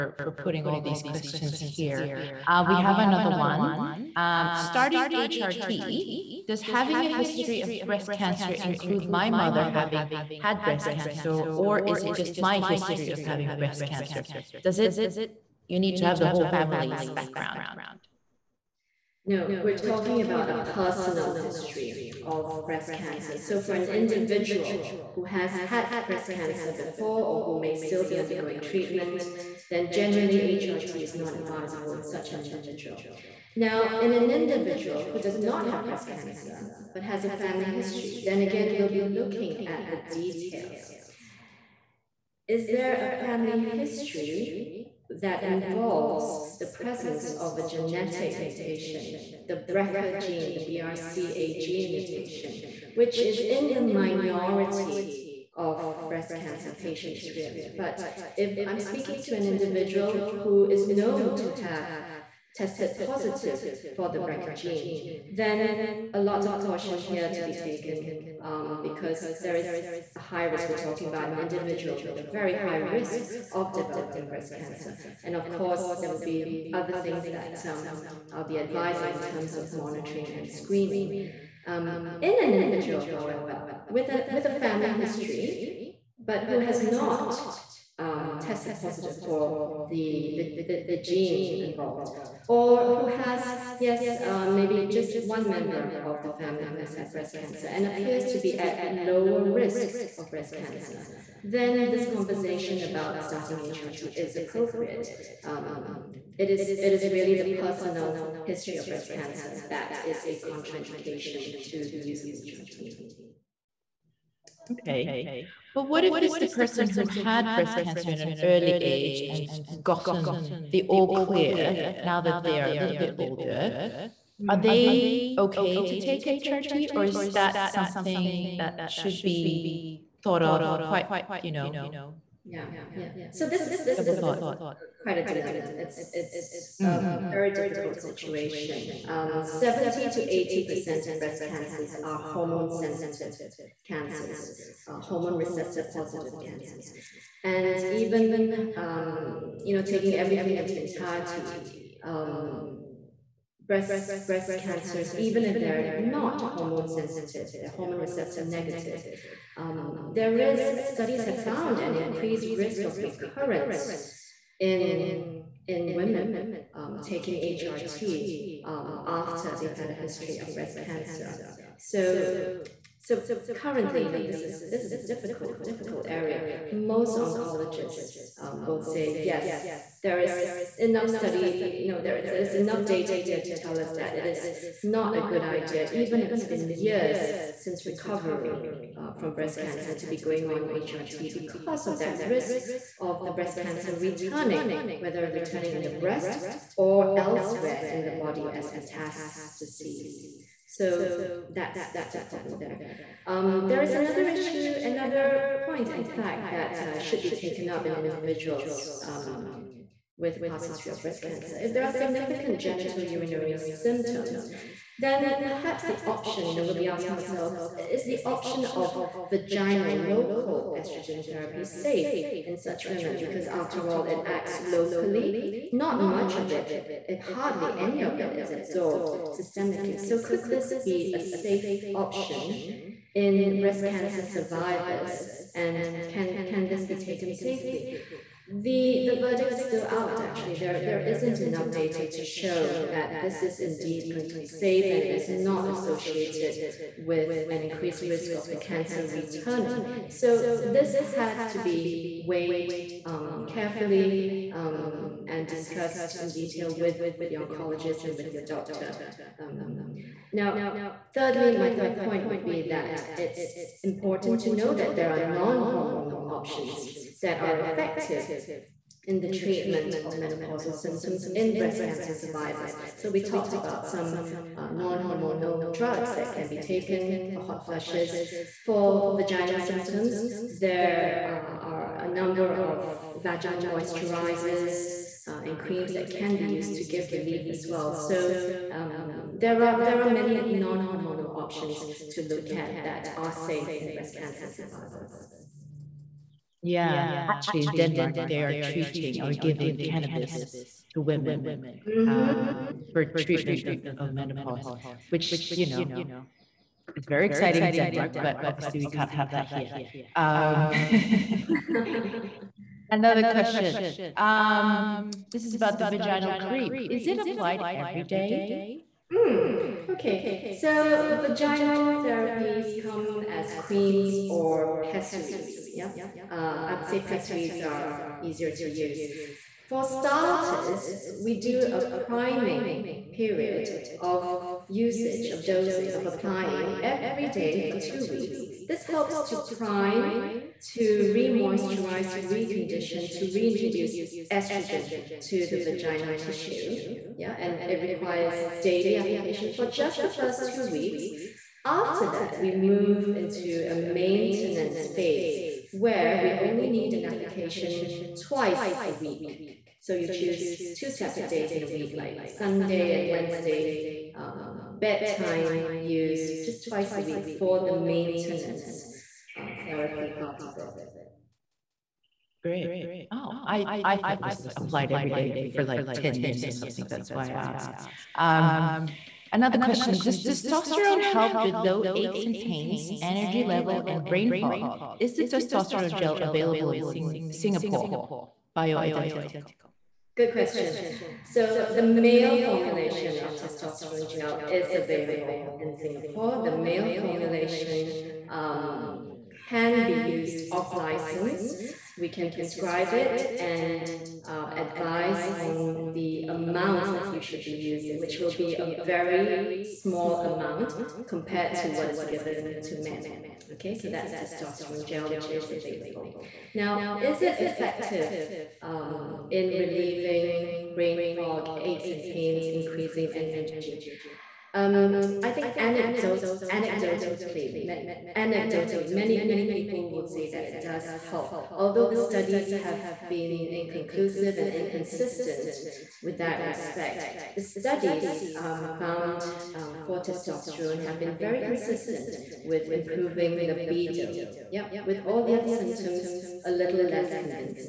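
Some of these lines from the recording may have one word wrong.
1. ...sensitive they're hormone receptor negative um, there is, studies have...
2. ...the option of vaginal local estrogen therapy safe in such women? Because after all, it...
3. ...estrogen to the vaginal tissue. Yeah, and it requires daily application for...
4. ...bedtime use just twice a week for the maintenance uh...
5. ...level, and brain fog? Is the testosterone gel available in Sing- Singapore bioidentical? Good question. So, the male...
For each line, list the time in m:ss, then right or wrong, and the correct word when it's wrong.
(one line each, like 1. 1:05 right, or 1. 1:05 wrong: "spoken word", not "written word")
1. 2:36 right
2. 3:38 right
3. 5:44 right
4. 6:04 right
5. 6:23 right.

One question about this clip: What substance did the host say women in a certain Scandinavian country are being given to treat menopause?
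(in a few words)
cannabis.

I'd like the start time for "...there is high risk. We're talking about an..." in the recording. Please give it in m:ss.
1:09.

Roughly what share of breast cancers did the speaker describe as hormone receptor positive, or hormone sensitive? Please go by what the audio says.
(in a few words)
70 to 80 percent.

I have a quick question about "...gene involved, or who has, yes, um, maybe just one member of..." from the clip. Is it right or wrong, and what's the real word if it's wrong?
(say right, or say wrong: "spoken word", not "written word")
right.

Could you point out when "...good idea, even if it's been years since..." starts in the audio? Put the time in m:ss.
3:05.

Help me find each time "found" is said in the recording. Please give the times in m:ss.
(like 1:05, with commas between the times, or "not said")
2:41, 7:18.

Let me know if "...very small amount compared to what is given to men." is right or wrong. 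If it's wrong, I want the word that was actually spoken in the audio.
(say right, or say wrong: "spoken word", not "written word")
right.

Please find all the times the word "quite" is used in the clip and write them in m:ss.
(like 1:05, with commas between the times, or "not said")
2:10, 2:15.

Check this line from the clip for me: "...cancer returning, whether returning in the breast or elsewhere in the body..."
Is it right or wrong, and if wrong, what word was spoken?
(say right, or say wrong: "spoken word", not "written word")
right.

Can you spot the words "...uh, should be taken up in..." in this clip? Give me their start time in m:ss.
3:26.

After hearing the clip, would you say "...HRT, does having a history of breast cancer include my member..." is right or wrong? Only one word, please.
wrong.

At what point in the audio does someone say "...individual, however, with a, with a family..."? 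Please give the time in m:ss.
1:22.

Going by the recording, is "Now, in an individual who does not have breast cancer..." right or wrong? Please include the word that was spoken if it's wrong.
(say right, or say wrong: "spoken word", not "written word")
right.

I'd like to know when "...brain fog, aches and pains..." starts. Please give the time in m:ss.
7:00.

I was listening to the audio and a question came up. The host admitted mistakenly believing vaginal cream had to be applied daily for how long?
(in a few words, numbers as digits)
10 years.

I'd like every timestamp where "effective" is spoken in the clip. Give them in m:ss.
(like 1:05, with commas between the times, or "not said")
4:27, 6:57.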